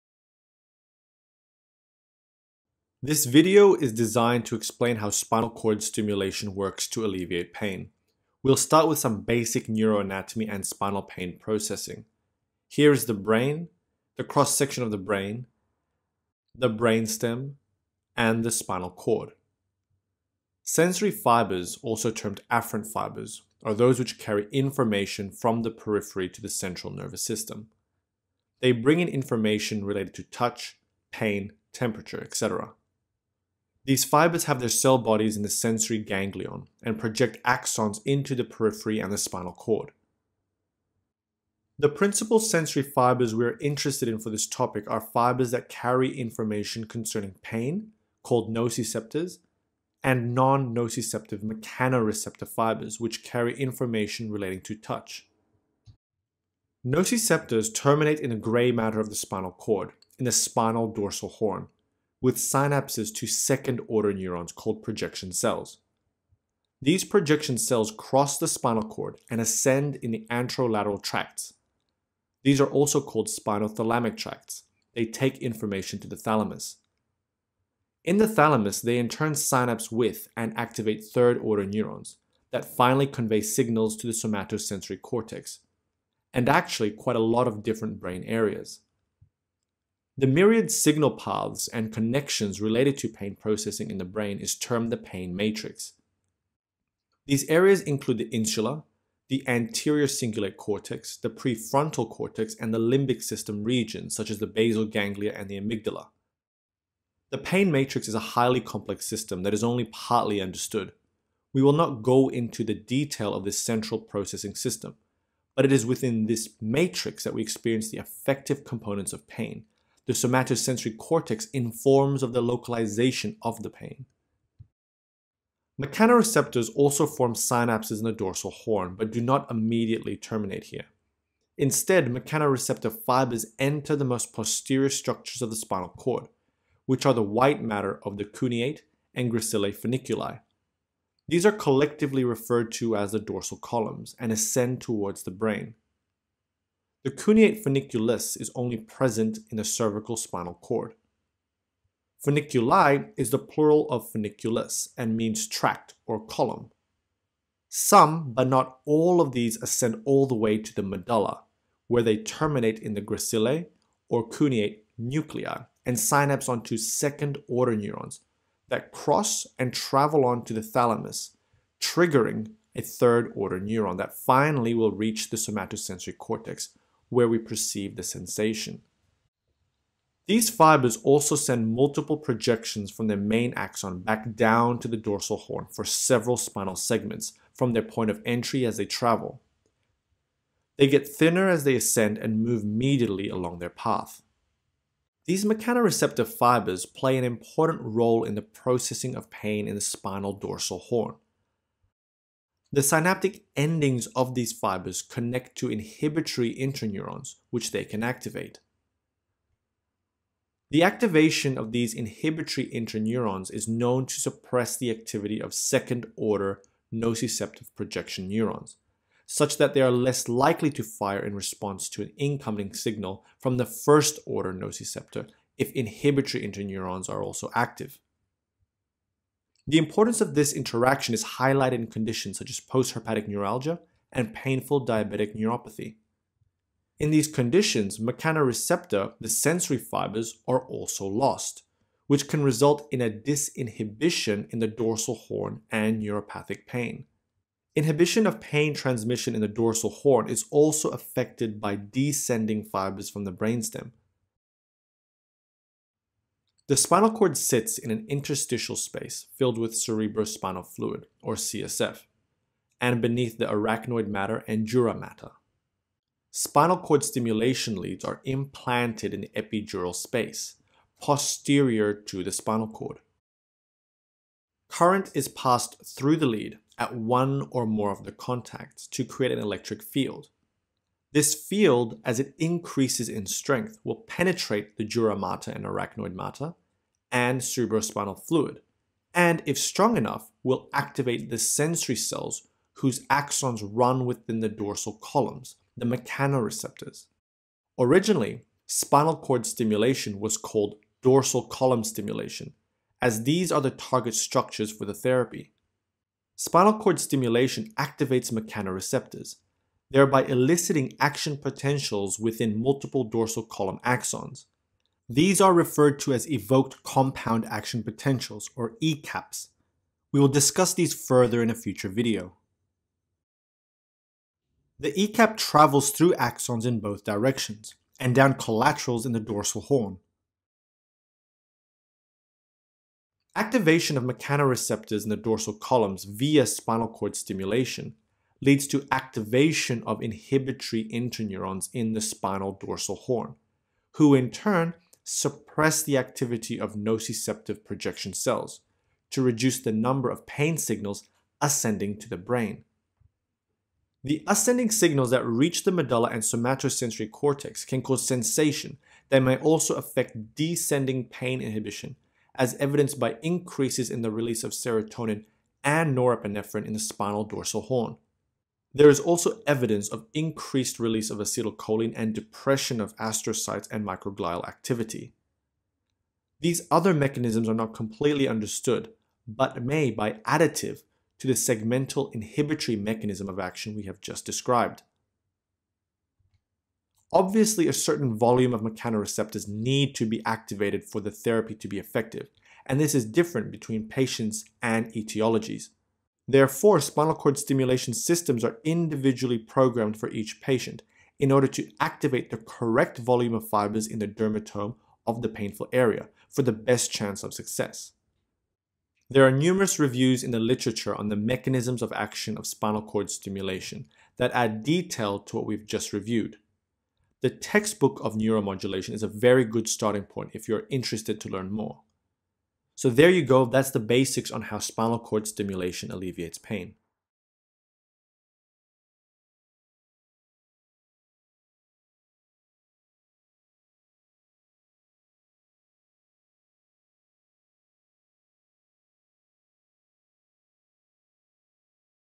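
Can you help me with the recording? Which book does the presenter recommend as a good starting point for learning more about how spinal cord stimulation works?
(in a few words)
The Textbook of Neuromodulation.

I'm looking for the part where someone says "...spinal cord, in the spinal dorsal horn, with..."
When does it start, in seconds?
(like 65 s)
59 s.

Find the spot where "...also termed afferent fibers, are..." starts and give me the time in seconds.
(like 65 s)
21 s.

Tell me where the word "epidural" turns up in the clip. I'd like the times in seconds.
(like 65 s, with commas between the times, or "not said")
269 s.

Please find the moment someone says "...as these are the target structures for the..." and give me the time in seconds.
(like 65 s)
303 s.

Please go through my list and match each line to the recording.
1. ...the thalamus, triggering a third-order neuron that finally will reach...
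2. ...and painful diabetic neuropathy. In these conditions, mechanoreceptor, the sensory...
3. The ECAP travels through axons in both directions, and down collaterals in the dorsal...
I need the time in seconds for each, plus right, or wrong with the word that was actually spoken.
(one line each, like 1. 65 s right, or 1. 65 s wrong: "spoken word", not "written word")
1. 170 s right
2. 234 s right
3. 324 s right.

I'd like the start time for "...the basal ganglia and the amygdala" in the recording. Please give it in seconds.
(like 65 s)
104 s.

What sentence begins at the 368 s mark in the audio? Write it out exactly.
There is also evidence of increased release of acetylcholine and depression of astrocytes and microglial activity.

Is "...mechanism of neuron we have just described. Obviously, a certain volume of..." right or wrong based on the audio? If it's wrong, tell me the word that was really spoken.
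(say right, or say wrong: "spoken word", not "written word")
wrong: "action", not "neuron".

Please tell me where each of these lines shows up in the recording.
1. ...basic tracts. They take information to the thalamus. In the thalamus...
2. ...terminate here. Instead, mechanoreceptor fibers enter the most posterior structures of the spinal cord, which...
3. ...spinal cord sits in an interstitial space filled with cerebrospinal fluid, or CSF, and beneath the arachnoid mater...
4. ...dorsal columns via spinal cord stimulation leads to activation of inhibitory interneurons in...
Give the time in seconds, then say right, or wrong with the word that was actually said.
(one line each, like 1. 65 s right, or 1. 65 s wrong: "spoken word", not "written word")
1. 73 s wrong: "spinothalamic", not "basic"
2. 130 s right
3. 256 s right
4. 335 s right.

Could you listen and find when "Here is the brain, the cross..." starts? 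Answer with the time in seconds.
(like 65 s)
12 s.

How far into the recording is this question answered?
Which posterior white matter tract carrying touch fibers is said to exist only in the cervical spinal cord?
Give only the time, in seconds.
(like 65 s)
147 s.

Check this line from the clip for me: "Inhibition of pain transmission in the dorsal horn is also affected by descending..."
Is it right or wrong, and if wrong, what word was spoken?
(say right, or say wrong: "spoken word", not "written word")
right.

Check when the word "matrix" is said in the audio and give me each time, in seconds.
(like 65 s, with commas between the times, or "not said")
95 s, 107 s, 116 s.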